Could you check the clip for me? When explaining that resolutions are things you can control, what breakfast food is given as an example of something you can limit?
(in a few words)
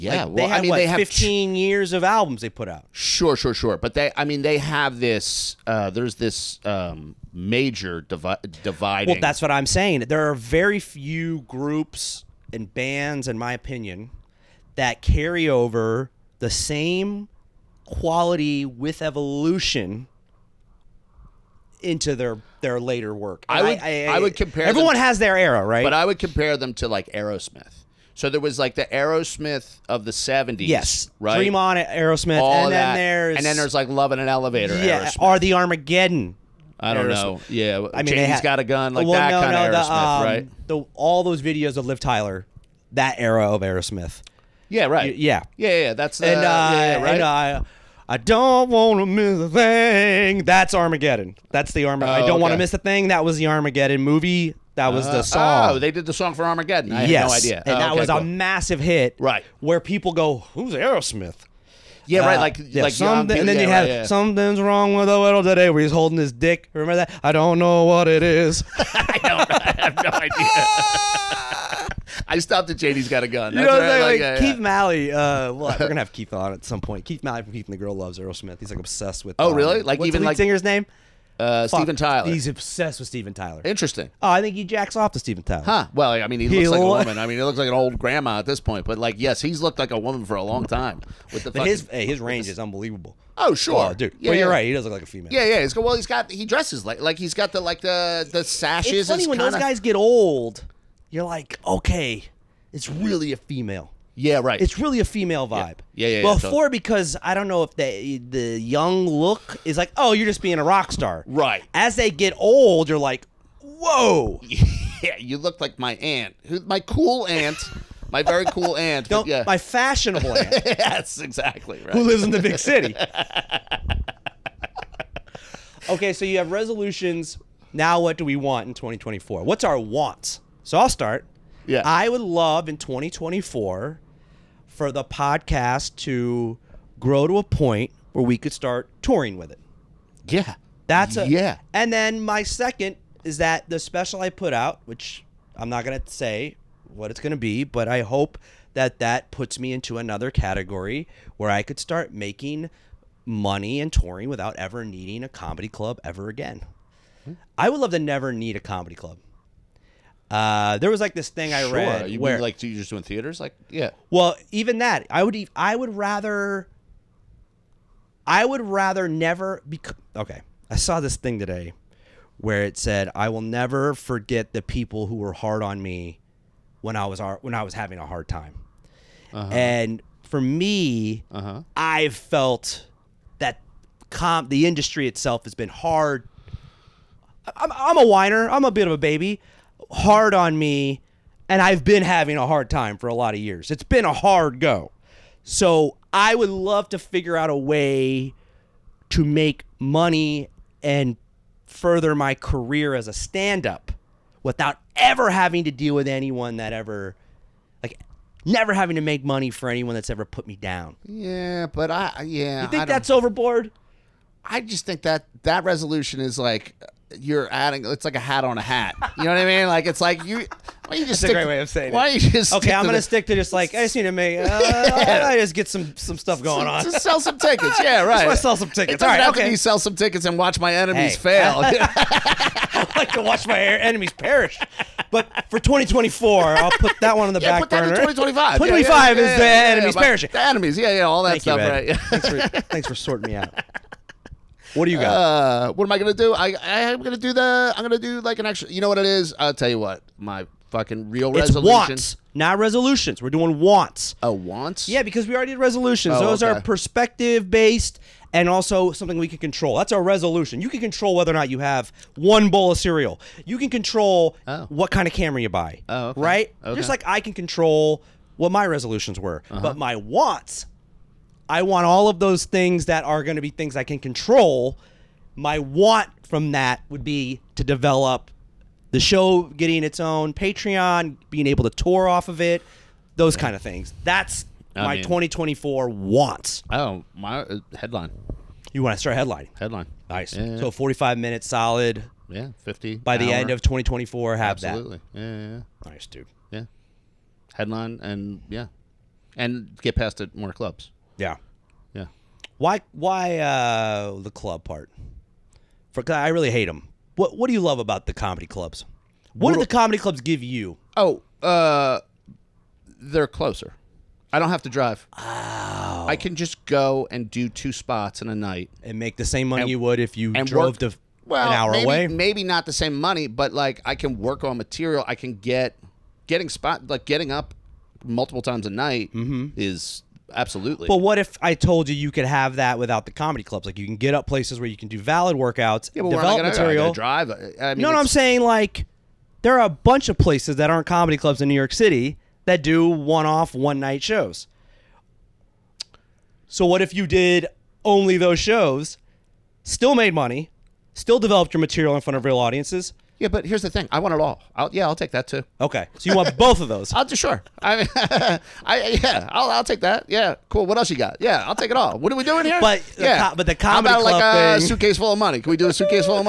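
cereal.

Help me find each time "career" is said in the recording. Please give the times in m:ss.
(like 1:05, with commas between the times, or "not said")
3:22.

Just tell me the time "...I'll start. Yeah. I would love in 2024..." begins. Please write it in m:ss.
2:10.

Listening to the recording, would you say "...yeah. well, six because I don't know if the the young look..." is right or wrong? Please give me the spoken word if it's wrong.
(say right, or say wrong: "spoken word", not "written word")
wrong: "four", not "six".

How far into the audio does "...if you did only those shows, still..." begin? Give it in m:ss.
5:46.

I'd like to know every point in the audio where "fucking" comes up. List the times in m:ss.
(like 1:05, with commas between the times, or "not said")
1:31, 4:10.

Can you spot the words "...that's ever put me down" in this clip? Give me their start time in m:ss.
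3:29.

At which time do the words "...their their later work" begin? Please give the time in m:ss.
0:22.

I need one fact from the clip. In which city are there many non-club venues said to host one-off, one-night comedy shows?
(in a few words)
New York City.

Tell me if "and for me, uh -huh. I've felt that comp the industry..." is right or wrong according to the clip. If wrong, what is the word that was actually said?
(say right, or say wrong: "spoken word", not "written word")
right.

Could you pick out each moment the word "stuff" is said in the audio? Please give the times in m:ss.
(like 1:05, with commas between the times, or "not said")
3:46, 4:01.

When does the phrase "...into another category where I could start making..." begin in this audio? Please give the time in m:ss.
2:29.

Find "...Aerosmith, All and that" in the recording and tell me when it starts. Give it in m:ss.
0:31.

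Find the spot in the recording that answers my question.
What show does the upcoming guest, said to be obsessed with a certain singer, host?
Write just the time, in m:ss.
1:17.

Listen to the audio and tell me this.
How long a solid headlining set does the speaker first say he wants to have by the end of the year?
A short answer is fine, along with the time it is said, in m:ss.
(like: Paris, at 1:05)
45 minutes, at 4:50.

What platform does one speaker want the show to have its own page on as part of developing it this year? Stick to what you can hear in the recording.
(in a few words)
Patreon.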